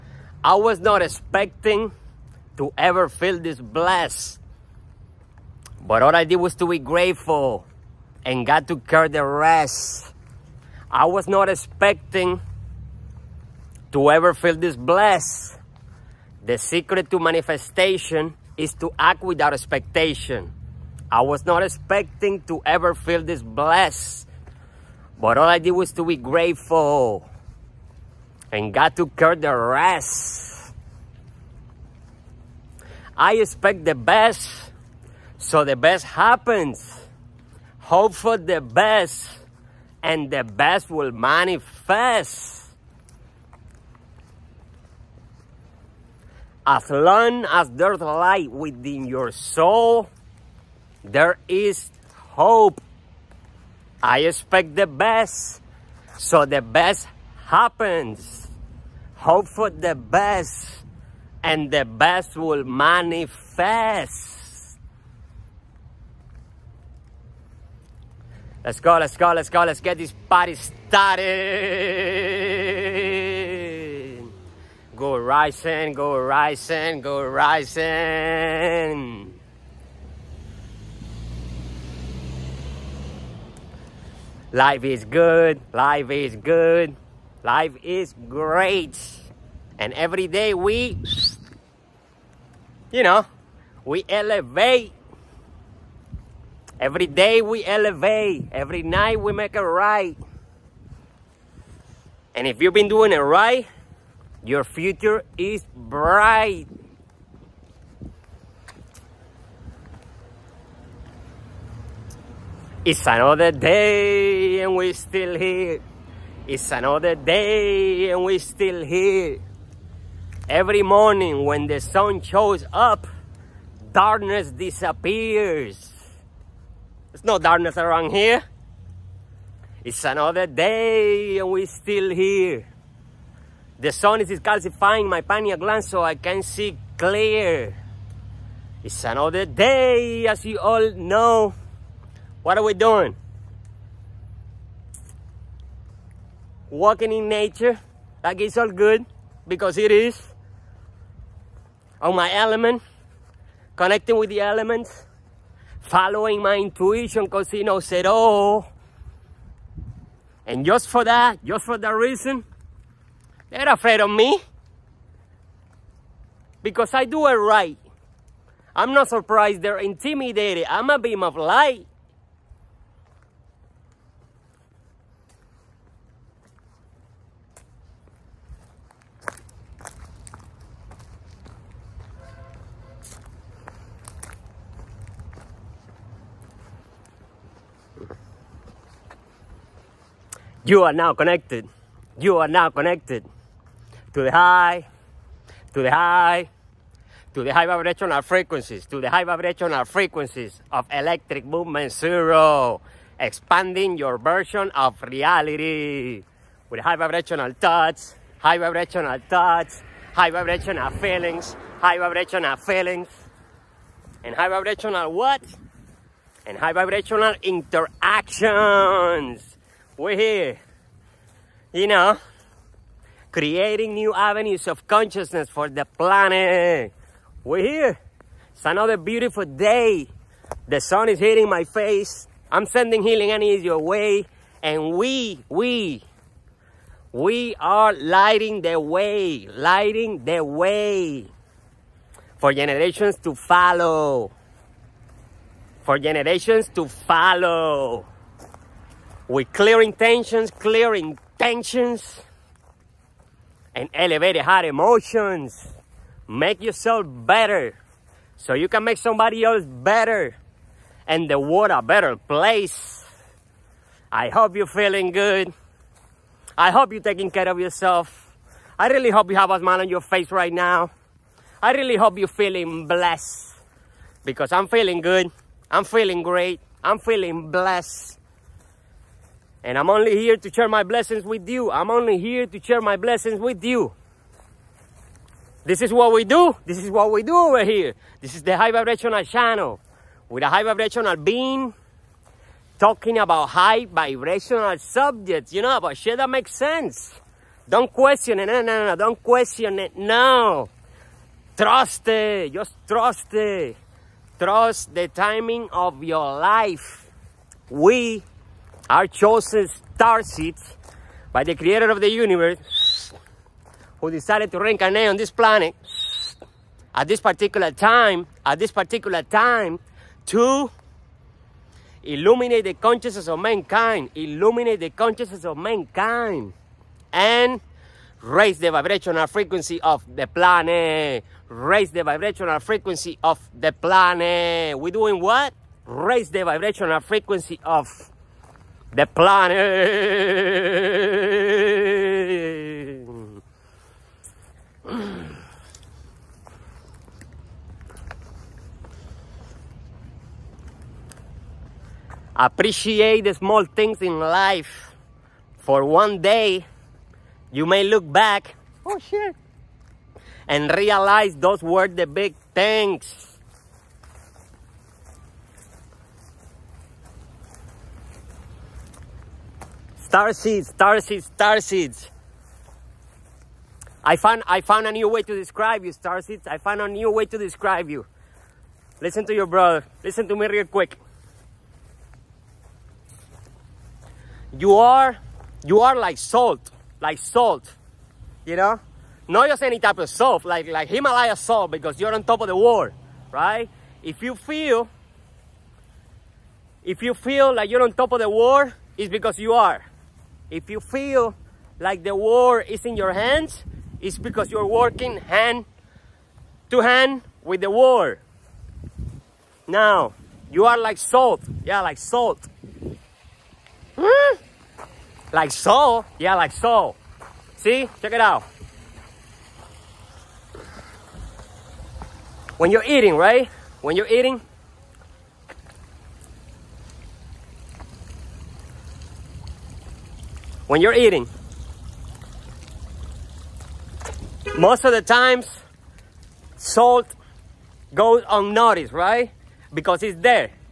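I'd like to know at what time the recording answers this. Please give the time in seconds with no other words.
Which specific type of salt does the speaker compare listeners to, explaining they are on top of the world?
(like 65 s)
390 s.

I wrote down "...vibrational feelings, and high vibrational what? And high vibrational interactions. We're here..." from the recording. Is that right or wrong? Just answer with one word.
right.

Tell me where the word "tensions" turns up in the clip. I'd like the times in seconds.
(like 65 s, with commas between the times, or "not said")
251 s.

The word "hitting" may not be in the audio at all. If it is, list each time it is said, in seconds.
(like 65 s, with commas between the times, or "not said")
231 s.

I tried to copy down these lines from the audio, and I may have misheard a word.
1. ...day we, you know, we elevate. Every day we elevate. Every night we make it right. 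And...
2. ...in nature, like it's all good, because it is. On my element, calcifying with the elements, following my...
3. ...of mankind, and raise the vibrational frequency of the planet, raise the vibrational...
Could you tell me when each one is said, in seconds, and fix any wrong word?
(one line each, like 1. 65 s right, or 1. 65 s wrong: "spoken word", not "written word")
1. 90 s right
2. 147 s wrong: "connecting", not "calcifying"
3. 325 s right.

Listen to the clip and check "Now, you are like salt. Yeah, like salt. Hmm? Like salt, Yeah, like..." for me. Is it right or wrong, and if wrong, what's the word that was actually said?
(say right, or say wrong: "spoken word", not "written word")
right.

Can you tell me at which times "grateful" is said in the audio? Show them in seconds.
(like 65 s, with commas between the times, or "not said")
6 s, 26 s.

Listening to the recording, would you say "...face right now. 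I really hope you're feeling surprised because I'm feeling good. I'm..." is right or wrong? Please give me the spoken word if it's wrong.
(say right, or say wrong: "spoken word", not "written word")
wrong: "blessed", not "surprised".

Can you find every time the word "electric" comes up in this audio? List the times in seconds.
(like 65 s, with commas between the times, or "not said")
200 s.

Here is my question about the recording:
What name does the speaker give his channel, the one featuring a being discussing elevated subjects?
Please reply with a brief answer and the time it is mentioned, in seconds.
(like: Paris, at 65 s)
High vibrational channel, at 288 s.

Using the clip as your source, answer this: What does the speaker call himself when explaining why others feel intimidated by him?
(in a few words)
A beam of light.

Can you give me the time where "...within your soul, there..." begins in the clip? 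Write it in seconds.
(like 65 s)
48 s.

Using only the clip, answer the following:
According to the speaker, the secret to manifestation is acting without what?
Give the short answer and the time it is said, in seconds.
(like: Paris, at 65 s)
Expectation, at 18 s.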